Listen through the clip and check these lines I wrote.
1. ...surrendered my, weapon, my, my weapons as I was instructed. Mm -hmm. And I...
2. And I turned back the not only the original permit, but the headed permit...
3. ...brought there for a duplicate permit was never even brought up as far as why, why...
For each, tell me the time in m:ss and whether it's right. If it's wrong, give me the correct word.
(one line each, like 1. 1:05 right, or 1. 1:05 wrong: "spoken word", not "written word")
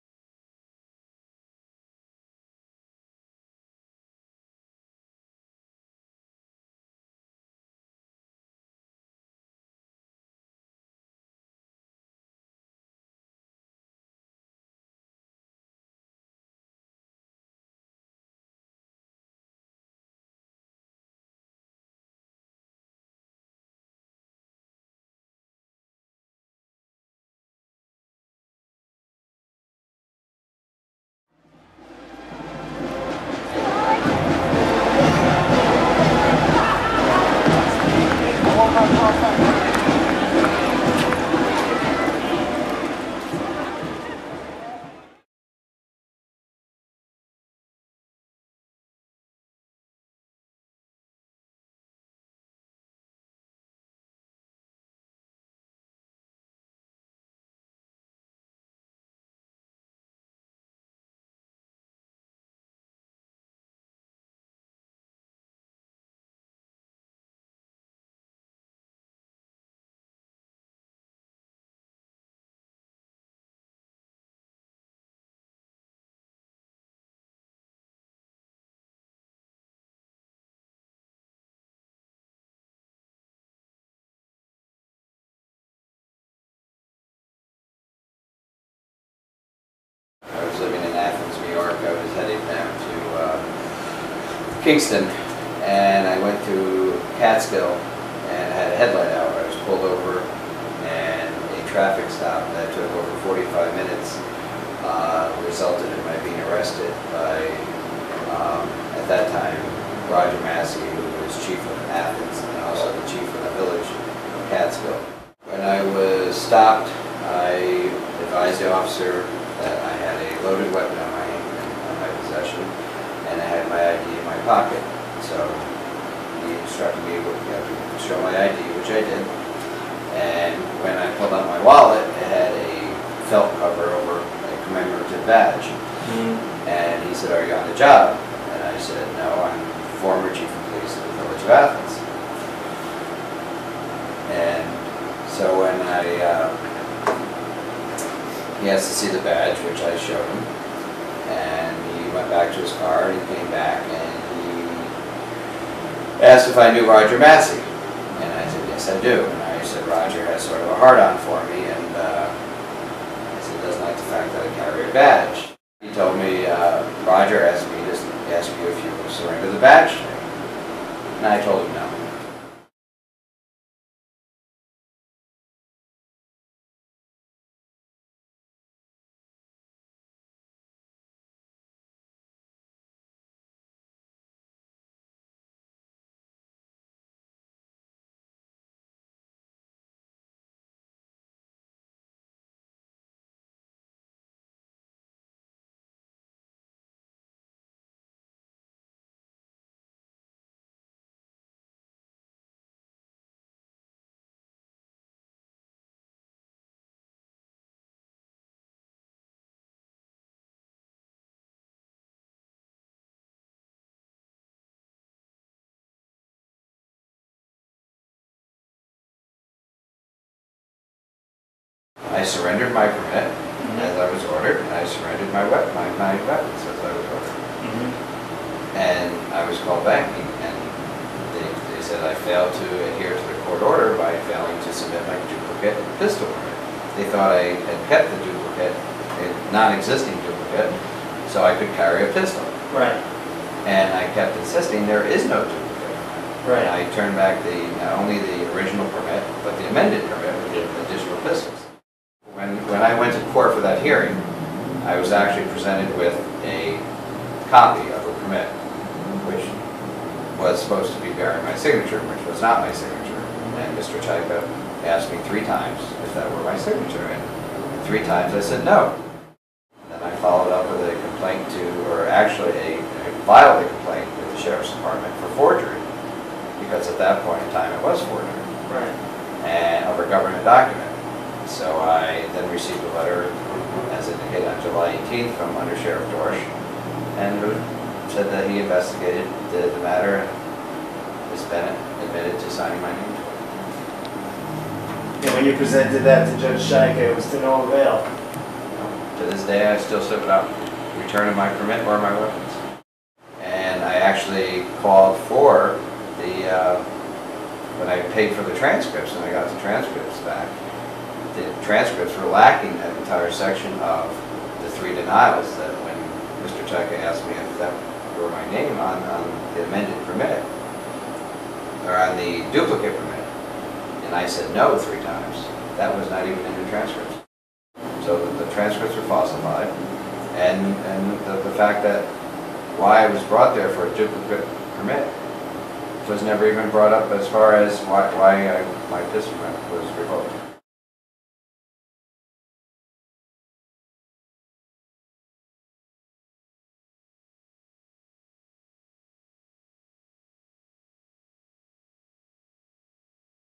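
1. 3:44 wrong: "ordered", not "instructed"
2. 4:06 wrong: "amended", not "headed"
3. 5:33 right.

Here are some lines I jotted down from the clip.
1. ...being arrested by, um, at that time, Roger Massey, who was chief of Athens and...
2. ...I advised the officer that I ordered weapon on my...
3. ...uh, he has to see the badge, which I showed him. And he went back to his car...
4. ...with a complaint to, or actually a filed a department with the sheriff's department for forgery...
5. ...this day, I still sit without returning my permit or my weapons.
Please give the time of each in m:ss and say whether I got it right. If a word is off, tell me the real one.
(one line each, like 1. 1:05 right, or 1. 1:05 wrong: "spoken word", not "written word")
1. 1:46 right
2. 1:57 wrong: "loaded", not "ordered"
3. 2:26 right
4. 4:30 wrong: "complaint", not "department"
5. 4:59 right.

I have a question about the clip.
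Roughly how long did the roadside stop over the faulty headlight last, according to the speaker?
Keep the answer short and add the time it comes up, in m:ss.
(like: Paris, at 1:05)
over 45 minutes, at 1:42.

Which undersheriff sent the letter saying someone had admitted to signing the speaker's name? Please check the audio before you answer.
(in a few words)
Dorsch.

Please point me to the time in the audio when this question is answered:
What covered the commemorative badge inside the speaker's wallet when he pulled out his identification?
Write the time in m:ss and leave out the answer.
2:12.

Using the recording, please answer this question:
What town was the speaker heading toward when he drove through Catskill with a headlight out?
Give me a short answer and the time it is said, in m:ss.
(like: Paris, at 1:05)
Kingston, at 1:34.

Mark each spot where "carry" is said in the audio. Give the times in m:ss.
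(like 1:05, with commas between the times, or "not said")
2:44, 4:01.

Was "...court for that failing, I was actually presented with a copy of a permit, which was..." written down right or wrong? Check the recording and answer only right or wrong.
wrong.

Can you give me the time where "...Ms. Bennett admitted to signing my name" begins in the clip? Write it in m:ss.
4:51.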